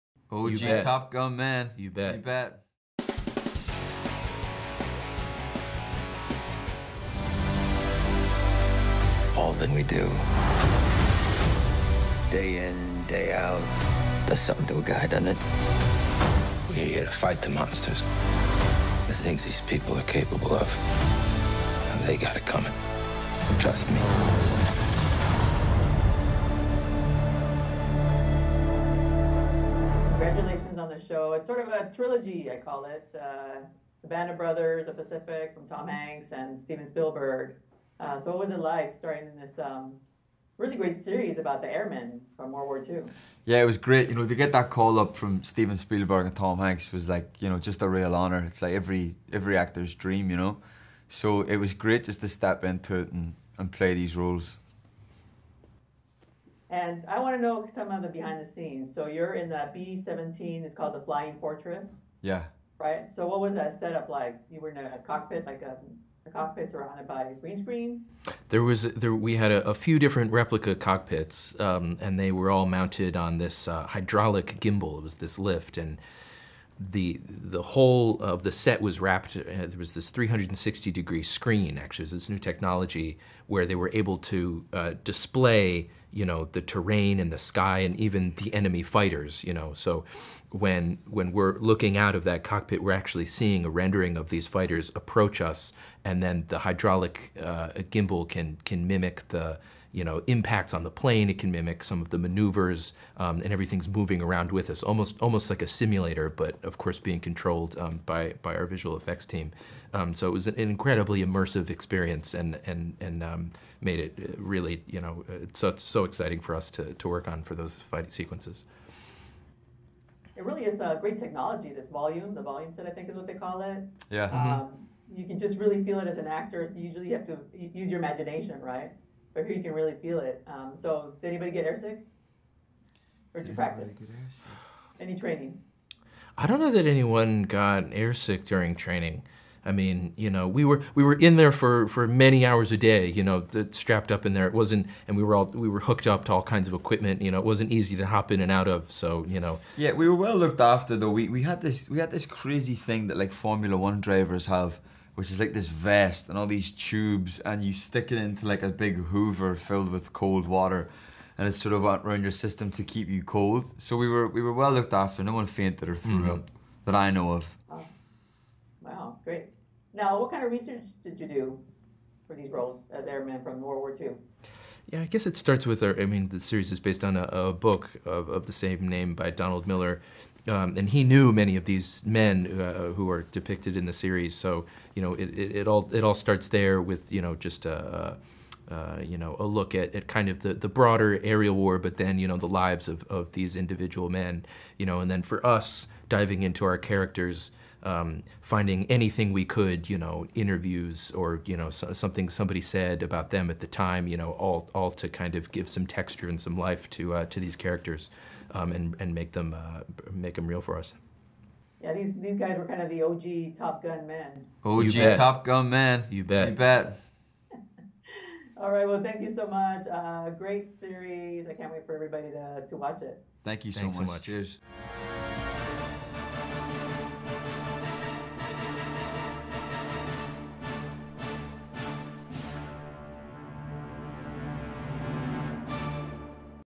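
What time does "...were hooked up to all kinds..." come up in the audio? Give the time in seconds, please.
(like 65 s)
145 s.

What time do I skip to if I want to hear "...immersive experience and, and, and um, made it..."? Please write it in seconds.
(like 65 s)
111 s.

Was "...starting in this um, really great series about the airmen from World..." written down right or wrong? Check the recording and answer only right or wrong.
right.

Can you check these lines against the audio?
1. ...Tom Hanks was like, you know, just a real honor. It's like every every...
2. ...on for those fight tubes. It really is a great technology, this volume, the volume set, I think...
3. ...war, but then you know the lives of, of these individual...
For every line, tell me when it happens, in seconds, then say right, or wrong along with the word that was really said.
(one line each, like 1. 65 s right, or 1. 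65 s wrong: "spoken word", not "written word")
1. 46 s right
2. 117 s wrong: "sequences", not "tubes"
3. 191 s right.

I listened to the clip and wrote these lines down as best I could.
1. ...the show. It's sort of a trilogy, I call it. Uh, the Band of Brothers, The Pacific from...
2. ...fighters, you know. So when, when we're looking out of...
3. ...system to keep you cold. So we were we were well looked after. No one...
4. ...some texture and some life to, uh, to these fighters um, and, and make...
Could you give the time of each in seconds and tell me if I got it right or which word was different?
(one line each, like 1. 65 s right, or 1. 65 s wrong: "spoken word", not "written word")
1. 30 s right
2. 88 s right
3. 162 s right
4. 205 s wrong: "characters", not "fighters".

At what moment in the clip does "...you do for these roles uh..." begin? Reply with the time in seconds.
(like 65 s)
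171 s.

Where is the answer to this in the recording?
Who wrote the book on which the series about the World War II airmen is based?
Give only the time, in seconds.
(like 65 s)
179 s.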